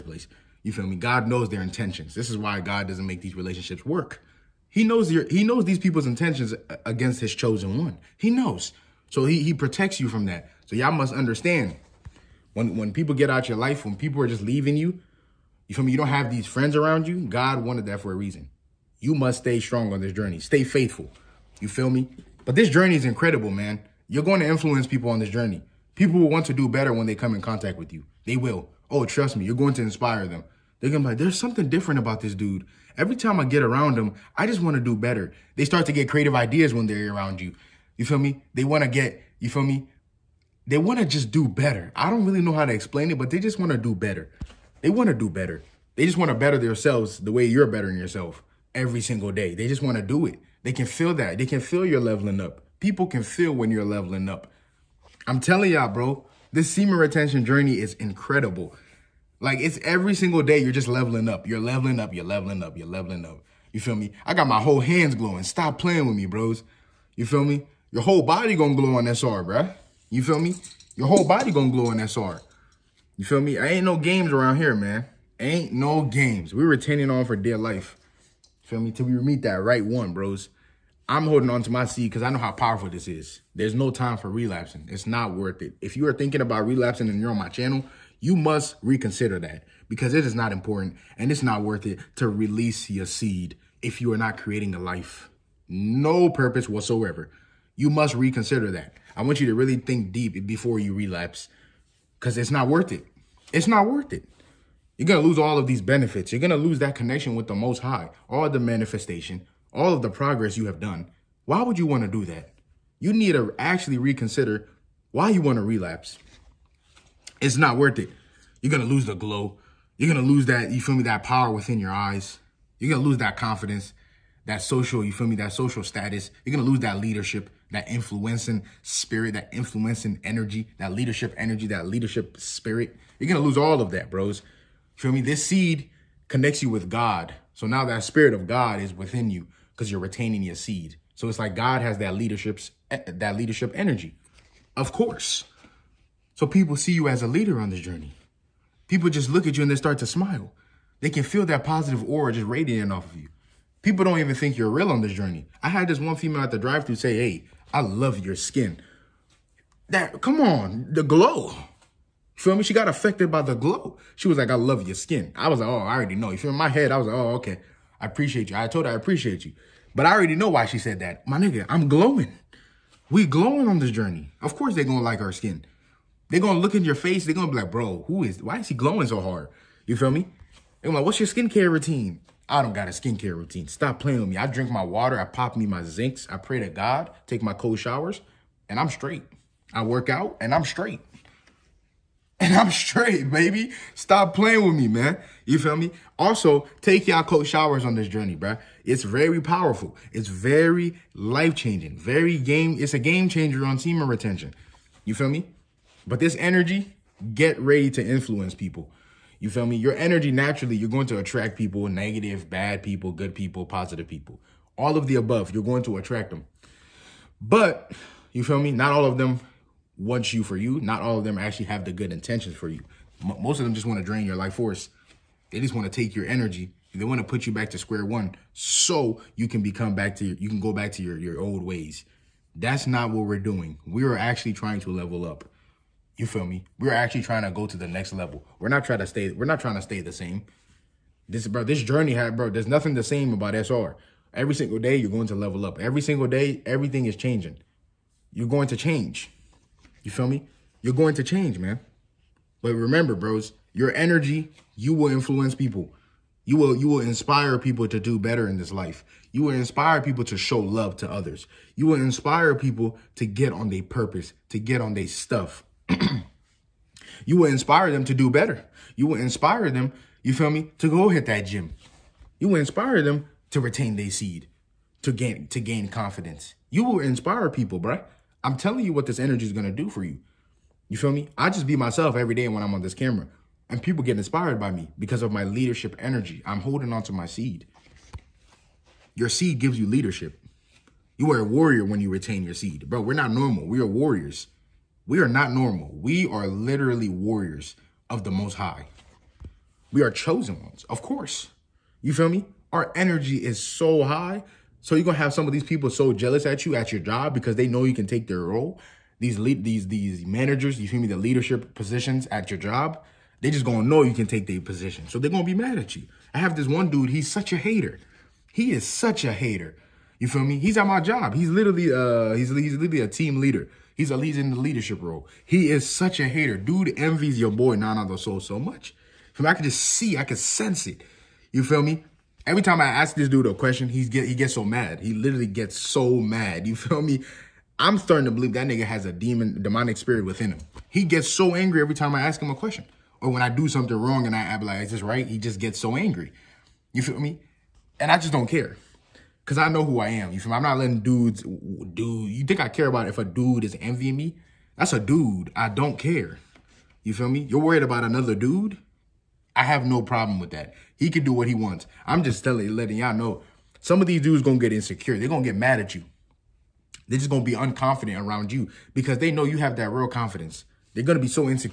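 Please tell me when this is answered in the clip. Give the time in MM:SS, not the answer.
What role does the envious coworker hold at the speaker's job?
05:23.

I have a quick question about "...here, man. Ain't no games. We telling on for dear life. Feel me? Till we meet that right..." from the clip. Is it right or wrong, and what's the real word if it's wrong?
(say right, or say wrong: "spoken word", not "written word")
wrong: "retaining", not "telling".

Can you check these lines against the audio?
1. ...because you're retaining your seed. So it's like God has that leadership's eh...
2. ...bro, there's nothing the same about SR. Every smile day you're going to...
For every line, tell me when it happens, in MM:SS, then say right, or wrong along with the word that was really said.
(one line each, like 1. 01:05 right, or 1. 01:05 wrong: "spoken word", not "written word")
1. 02:19 right
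2. 04:02 wrong: "single", not "smile".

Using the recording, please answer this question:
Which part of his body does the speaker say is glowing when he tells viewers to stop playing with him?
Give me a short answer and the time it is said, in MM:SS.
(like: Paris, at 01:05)
hands, at 01:04.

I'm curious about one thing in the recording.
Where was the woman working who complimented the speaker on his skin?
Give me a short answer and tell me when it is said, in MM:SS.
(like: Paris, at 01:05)
drive-through, at 02:36.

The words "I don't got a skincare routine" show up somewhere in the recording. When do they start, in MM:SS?
03:02.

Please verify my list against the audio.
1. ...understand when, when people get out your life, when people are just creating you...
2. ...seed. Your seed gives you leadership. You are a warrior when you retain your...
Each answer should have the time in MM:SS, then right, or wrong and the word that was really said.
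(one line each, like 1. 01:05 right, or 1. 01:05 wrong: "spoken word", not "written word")
1. 00:11 wrong: "leaving", not "creating"
2. 04:47 right.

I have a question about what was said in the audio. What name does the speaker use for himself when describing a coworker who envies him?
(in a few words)
Nana the Soul.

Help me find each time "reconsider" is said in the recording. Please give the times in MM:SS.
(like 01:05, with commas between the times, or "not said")
01:28, 01:38, 01:53.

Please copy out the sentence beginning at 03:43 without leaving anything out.
M most of them just want to drain your life force.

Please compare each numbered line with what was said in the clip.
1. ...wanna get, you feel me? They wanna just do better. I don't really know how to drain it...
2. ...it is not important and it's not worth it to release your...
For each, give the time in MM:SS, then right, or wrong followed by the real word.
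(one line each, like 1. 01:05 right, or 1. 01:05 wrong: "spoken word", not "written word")
1. 00:38 wrong: "explain", not "drain"
2. 01:30 right.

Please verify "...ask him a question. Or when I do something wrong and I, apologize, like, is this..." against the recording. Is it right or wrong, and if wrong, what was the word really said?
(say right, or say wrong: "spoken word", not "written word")
right.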